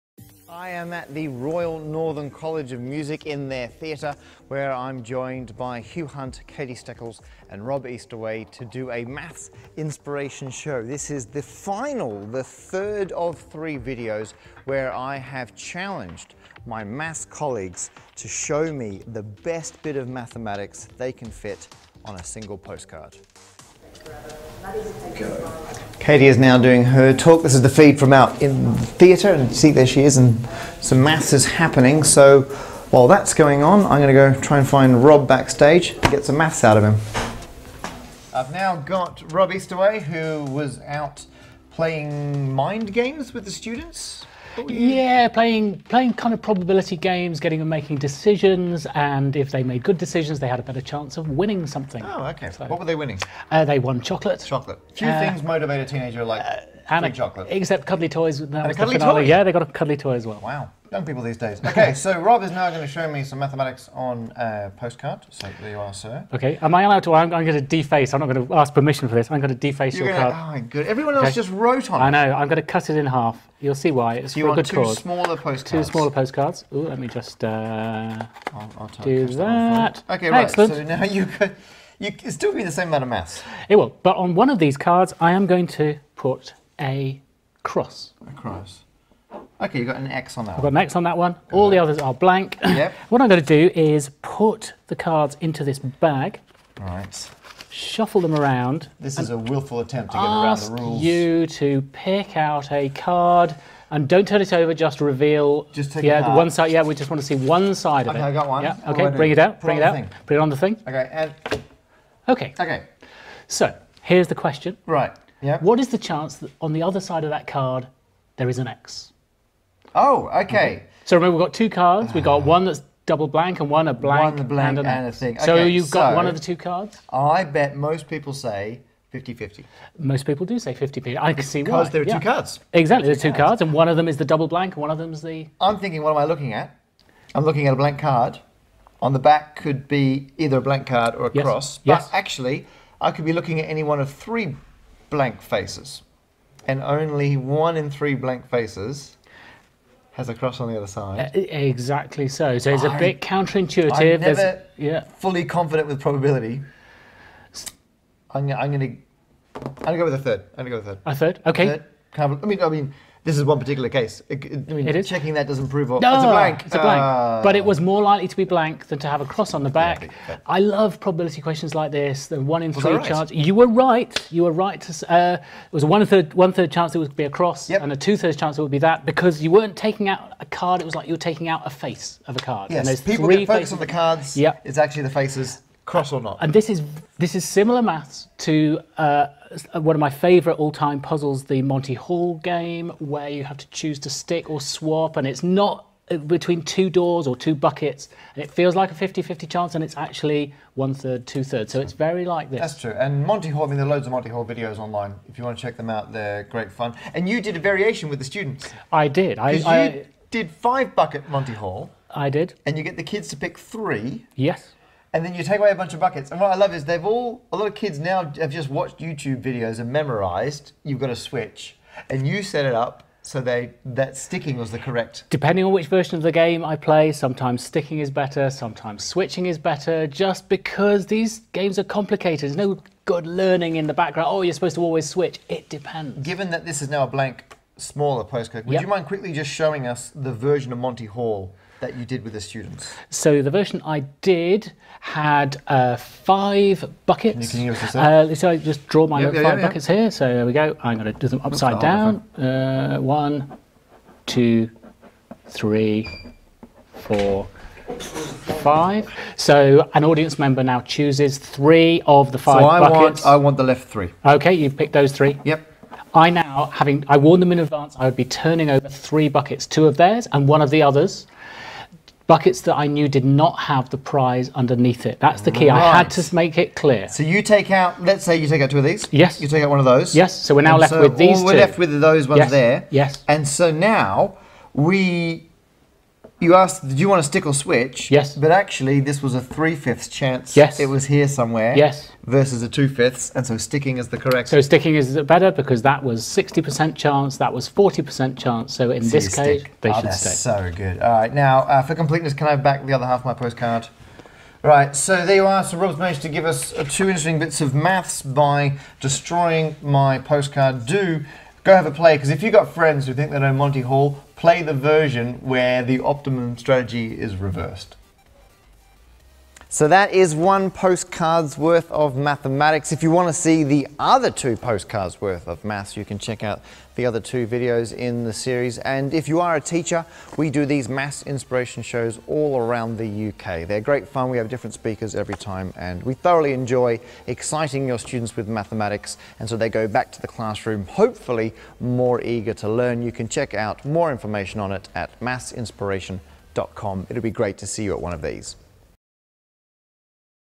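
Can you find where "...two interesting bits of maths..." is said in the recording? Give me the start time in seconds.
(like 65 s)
306 s.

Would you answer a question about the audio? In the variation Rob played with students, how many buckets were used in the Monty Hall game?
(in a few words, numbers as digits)
5.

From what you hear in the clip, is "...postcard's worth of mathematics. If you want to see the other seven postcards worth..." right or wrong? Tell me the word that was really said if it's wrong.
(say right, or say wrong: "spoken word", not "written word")
wrong: "two", not "seven".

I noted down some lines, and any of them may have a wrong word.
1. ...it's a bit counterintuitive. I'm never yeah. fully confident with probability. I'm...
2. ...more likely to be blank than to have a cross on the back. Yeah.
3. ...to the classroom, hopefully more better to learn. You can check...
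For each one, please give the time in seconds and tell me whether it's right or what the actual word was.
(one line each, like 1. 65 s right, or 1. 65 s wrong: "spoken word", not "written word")
1. 152 s right
2. 167 s right
3. 340 s wrong: "eager", not "better".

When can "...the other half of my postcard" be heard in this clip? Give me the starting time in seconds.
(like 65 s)
302 s.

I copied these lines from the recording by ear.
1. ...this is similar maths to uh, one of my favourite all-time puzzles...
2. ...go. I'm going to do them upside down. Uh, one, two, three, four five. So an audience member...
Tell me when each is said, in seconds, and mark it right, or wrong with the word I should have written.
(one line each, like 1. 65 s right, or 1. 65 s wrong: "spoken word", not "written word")
1. 187 s right
2. 250 s right.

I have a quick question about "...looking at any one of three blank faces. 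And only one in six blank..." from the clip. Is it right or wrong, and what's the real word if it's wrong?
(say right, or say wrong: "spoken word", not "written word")
wrong: "three", not "six".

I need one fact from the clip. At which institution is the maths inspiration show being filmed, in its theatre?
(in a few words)
Royal Northern College of Music.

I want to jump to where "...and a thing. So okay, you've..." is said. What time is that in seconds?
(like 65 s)
124 s.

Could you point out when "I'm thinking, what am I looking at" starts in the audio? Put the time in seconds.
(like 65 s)
135 s.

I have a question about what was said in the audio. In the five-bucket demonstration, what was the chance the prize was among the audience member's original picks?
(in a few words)
Three fifths.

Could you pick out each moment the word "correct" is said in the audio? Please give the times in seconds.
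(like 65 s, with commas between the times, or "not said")
224 s, 294 s.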